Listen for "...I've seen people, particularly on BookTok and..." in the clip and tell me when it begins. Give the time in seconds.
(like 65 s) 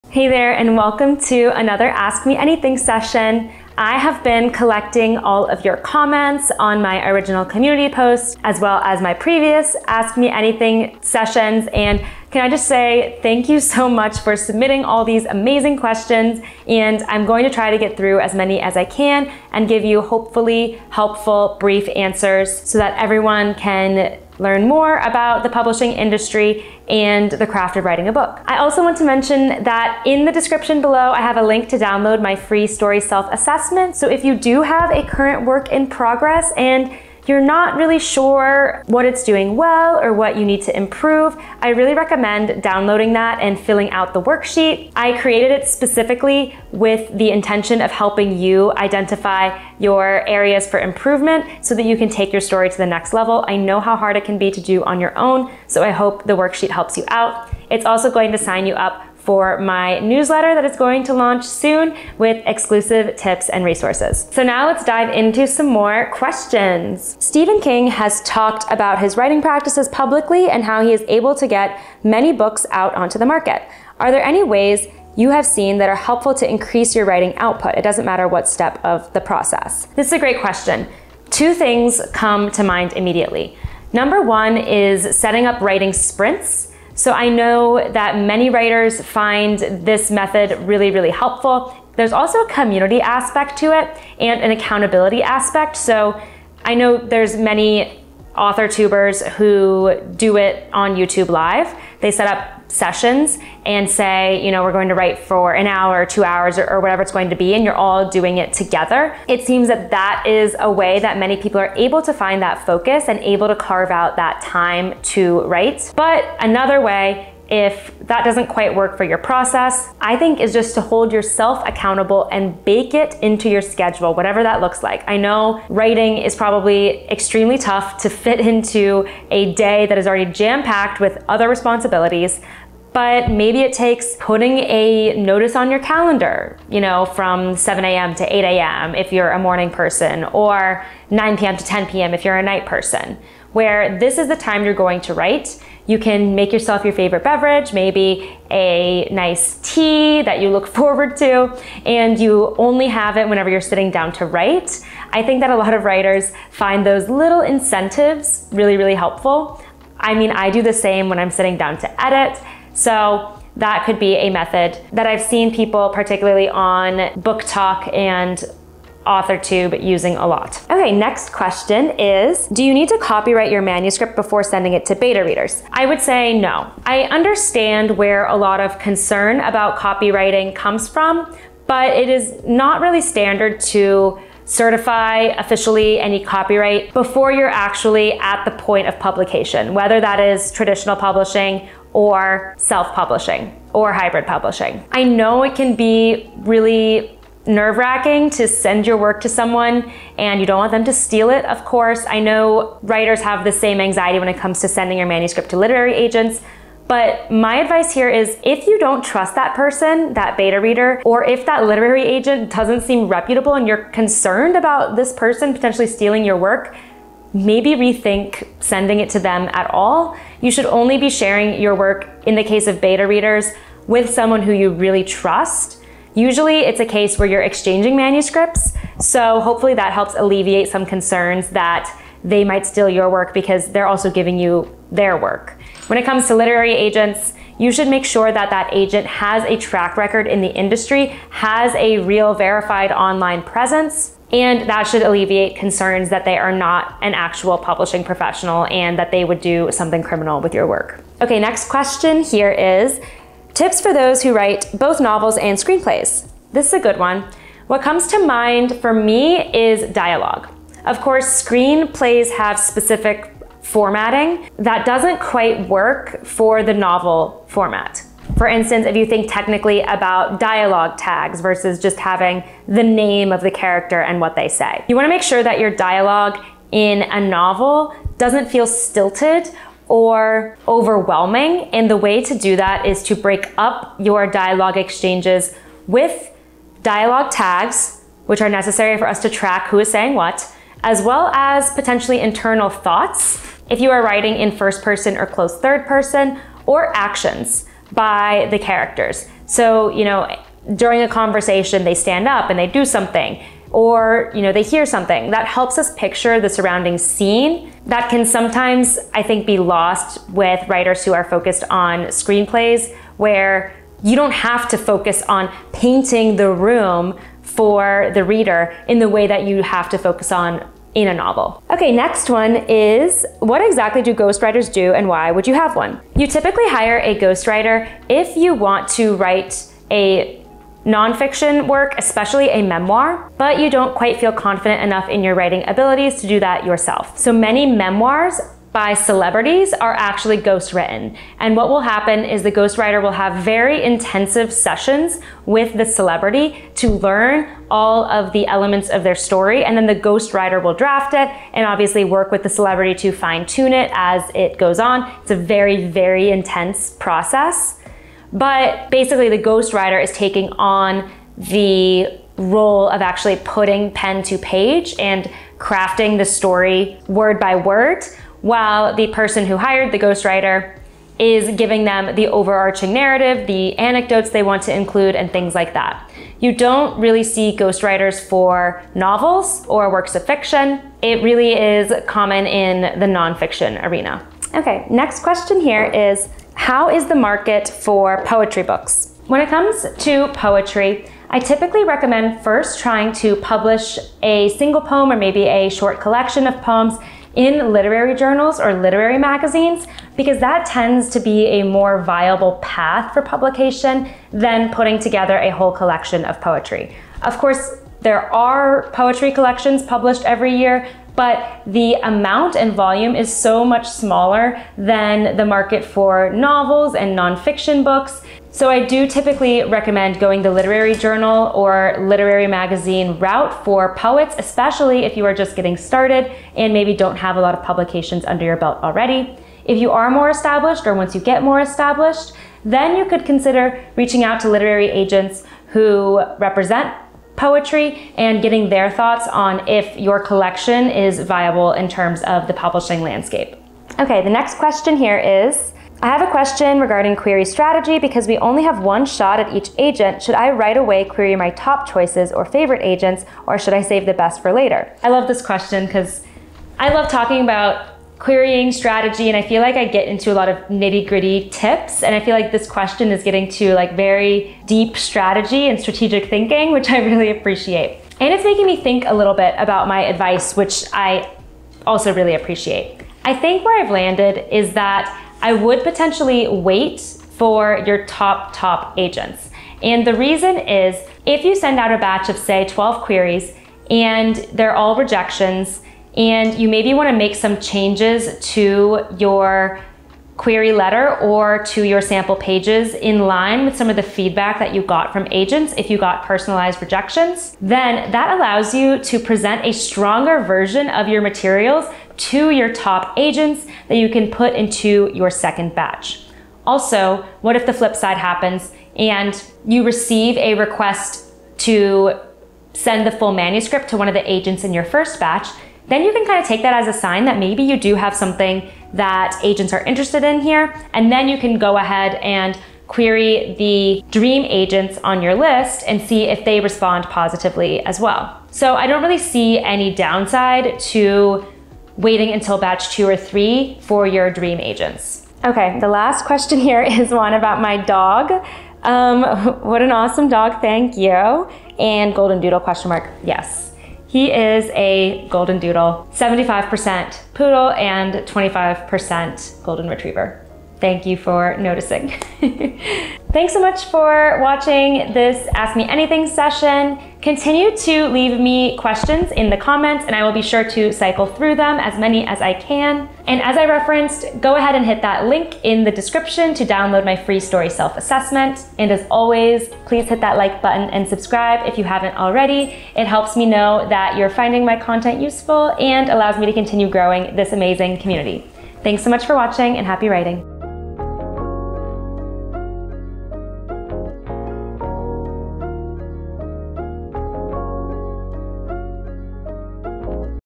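165 s.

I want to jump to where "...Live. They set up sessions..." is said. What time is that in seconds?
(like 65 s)
101 s.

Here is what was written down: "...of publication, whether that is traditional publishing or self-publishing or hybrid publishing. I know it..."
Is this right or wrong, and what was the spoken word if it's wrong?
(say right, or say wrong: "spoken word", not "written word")
right.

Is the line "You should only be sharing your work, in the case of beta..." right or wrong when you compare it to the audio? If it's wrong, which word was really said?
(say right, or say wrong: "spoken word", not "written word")
right.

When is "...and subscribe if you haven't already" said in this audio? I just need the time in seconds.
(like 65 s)
570 s.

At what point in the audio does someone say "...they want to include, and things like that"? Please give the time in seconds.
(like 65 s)
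374 s.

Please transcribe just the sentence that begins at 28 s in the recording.
I also want to mention that in the description below, I have a link to download my free story self-assessment.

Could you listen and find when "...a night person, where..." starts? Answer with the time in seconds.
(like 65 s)
142 s.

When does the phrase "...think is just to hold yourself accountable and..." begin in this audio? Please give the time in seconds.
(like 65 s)
120 s.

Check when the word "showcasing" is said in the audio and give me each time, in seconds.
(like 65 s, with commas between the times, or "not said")
not said.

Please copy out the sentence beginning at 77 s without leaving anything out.
It doesn't matter what step of the process.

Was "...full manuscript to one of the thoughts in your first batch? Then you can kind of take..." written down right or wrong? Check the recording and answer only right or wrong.
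wrong.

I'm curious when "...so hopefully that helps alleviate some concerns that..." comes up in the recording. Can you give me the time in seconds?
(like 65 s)
228 s.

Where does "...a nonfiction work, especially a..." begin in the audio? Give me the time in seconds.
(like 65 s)
329 s.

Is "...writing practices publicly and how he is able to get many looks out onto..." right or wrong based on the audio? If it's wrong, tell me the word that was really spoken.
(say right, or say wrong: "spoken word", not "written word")
wrong: "books", not "looks".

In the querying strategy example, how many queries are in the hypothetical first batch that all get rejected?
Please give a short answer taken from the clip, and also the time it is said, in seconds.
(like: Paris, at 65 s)
12, at 482 s.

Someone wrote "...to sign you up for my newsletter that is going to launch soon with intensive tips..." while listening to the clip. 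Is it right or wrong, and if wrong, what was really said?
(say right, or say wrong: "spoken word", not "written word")
wrong: "exclusive", not "intensive".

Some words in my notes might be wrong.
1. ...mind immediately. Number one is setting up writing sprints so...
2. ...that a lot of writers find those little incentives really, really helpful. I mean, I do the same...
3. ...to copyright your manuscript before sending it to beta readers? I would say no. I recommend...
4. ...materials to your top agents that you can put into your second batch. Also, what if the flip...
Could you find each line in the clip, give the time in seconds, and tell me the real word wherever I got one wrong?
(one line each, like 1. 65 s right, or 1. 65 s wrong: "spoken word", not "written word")
1. 82 s right
2. 155 s right
3. 172 s wrong: "understand", not "recommend"
4. 501 s right.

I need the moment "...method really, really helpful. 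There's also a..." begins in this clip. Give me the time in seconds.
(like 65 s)
90 s.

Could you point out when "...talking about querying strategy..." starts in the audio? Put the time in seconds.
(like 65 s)
457 s.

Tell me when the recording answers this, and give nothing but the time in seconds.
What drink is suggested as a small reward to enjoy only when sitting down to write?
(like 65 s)
149 s.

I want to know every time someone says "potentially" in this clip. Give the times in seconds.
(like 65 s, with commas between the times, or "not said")
215 s, 291 s, 475 s.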